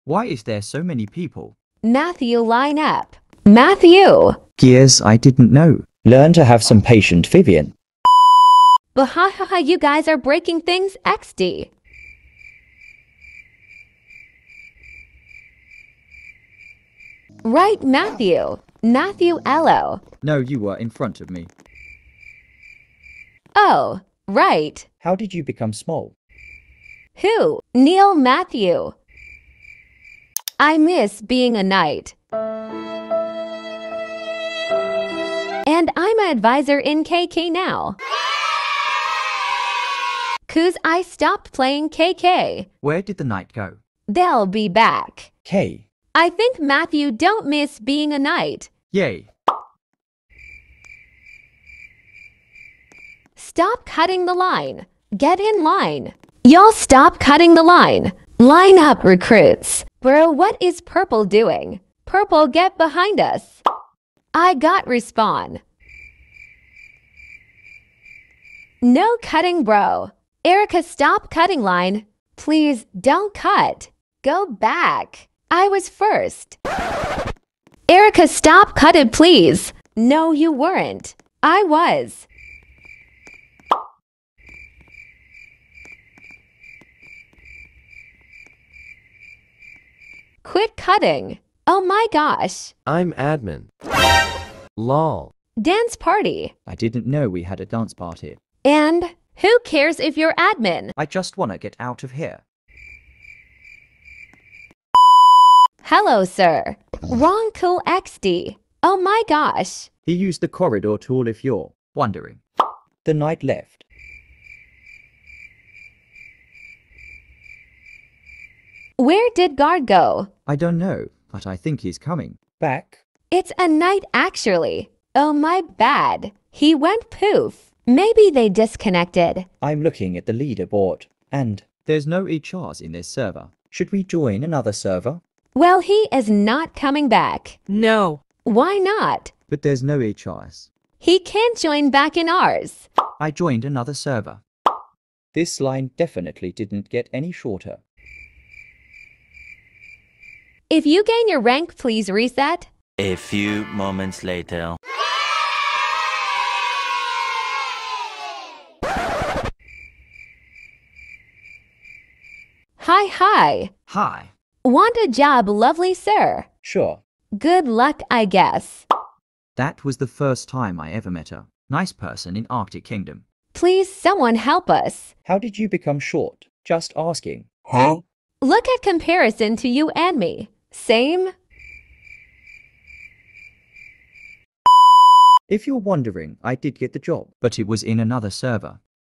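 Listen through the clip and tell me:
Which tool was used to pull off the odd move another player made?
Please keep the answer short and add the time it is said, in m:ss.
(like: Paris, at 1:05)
Corridor tool, at 1:50.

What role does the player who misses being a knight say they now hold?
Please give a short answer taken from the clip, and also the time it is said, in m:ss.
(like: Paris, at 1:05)
Advisor, at 0:36.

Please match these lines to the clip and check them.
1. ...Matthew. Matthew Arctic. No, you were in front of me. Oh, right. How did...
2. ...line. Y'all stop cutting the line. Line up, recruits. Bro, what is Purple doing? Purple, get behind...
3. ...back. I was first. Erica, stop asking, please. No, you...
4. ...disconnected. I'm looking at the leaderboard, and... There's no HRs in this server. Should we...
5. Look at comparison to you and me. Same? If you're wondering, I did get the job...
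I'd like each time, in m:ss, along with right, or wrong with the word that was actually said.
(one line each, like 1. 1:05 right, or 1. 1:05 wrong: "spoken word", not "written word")
1. 0:17 wrong: "Ello", not "Arctic"
2. 0:55 right
3. 1:14 wrong: "cutting", not "asking"
4. 2:08 right
5. 2:58 right.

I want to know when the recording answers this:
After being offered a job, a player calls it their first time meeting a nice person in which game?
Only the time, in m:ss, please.
2:52.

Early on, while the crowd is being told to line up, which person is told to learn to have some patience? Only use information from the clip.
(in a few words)
Vivian.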